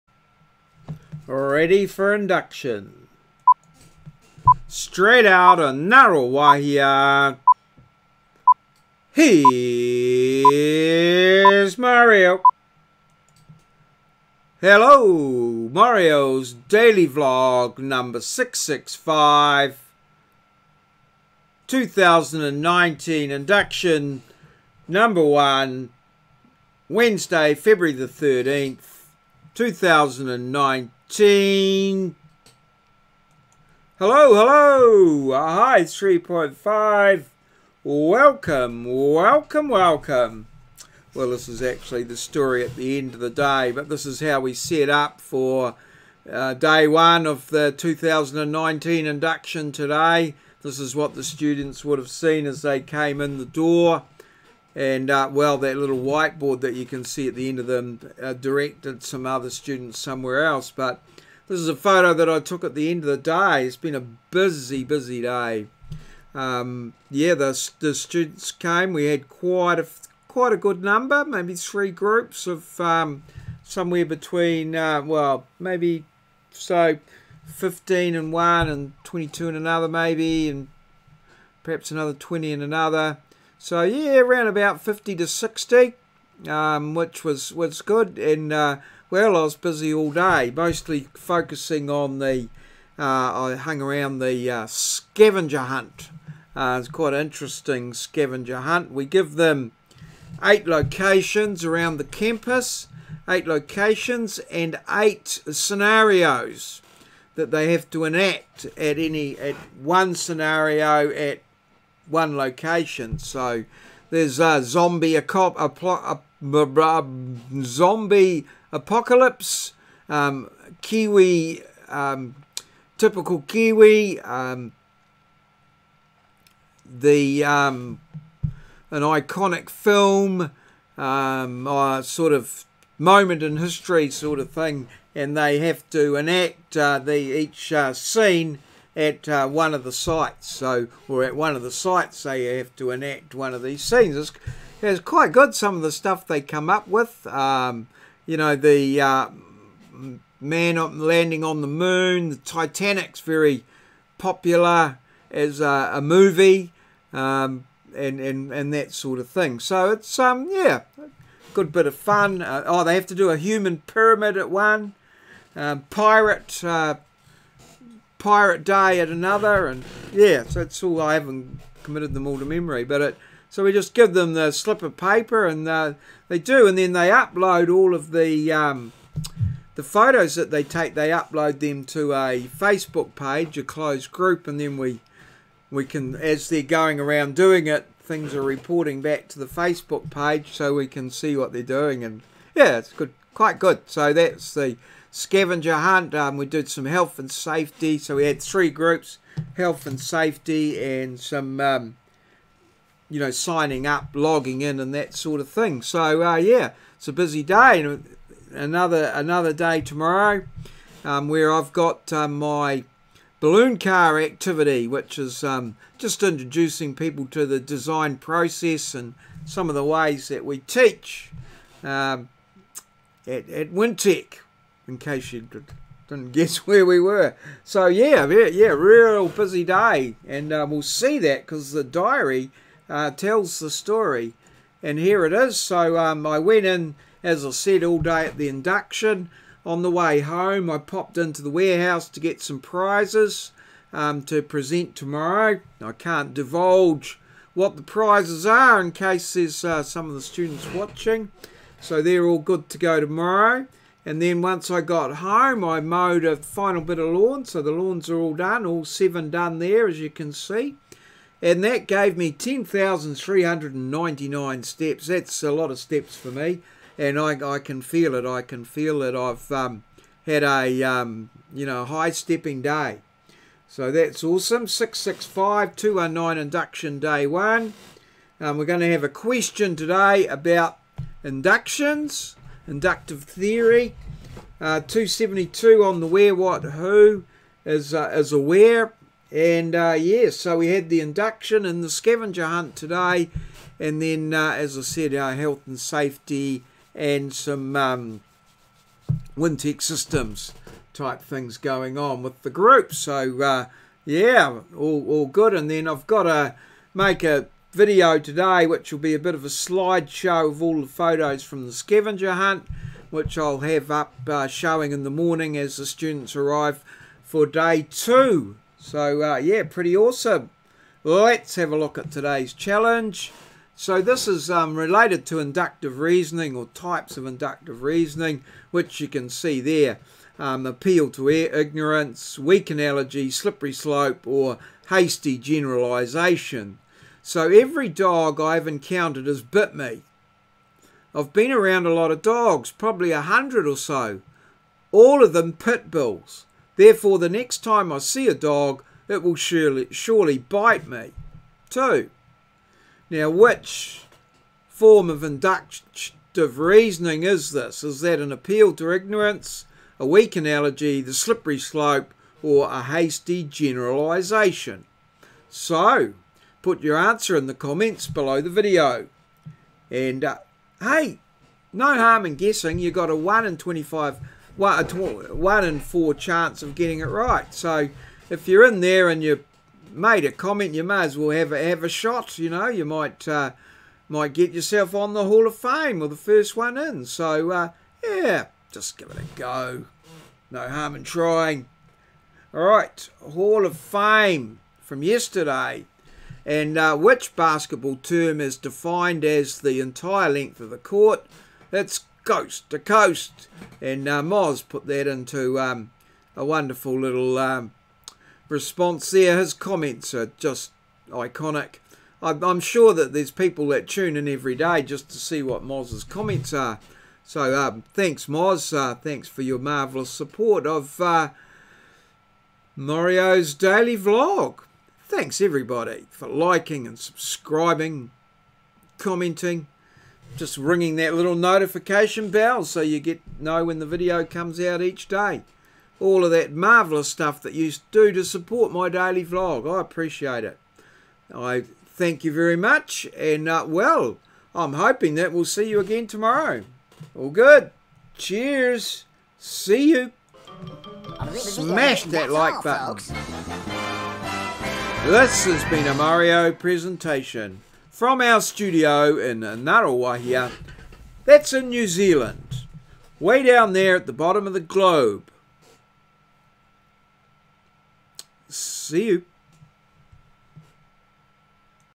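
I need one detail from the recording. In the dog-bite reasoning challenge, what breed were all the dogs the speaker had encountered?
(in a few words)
Pit bulls.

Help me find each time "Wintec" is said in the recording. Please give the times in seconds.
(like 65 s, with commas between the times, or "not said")
223 s, 299 s.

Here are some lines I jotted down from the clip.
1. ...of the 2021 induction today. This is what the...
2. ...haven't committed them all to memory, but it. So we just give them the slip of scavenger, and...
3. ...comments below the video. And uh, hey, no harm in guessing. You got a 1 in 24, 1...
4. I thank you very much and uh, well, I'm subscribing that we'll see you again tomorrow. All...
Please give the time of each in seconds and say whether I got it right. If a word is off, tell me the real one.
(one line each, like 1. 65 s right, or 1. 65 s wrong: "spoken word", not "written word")
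1. 47 s wrong: "2019", not "2021"
2. 171 s wrong: "paper", not "scavenger"
3. 367 s wrong: "25", not "24"
4. 441 s wrong: "hoping", not "subscribing".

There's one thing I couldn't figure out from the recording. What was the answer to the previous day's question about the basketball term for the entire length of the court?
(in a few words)
Coast to coast.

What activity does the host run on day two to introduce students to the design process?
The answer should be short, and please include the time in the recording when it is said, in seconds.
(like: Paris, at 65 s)
Balloon car activity, at 213 s.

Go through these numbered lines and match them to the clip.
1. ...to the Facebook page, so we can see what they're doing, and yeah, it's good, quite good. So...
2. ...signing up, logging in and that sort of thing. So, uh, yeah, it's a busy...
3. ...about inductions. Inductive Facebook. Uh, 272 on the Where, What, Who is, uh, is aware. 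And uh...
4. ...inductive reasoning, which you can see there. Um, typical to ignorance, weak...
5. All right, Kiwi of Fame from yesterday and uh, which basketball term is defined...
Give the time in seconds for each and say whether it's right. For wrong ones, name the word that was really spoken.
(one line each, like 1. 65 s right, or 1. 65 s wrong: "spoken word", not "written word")
1. 189 s right
2. 203 s right
3. 280 s wrong: "Theory", not "Facebook"
4. 327 s wrong: "appeal", not "typical"
5. 392 s wrong: "Hall", not "Kiwi".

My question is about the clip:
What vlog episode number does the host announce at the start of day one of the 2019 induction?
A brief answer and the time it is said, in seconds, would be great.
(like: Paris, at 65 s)
665, at 17 s.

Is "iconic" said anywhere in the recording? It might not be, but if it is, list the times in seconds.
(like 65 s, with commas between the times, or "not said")
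129 s, 411 s.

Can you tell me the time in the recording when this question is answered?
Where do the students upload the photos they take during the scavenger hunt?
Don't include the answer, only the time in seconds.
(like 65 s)
182 s.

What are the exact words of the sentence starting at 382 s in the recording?
You know, you might uh, might get yourself on the Hall of Fame or the first one in.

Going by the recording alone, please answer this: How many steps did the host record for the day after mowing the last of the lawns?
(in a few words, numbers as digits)
10,399.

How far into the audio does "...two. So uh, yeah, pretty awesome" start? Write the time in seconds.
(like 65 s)
317 s.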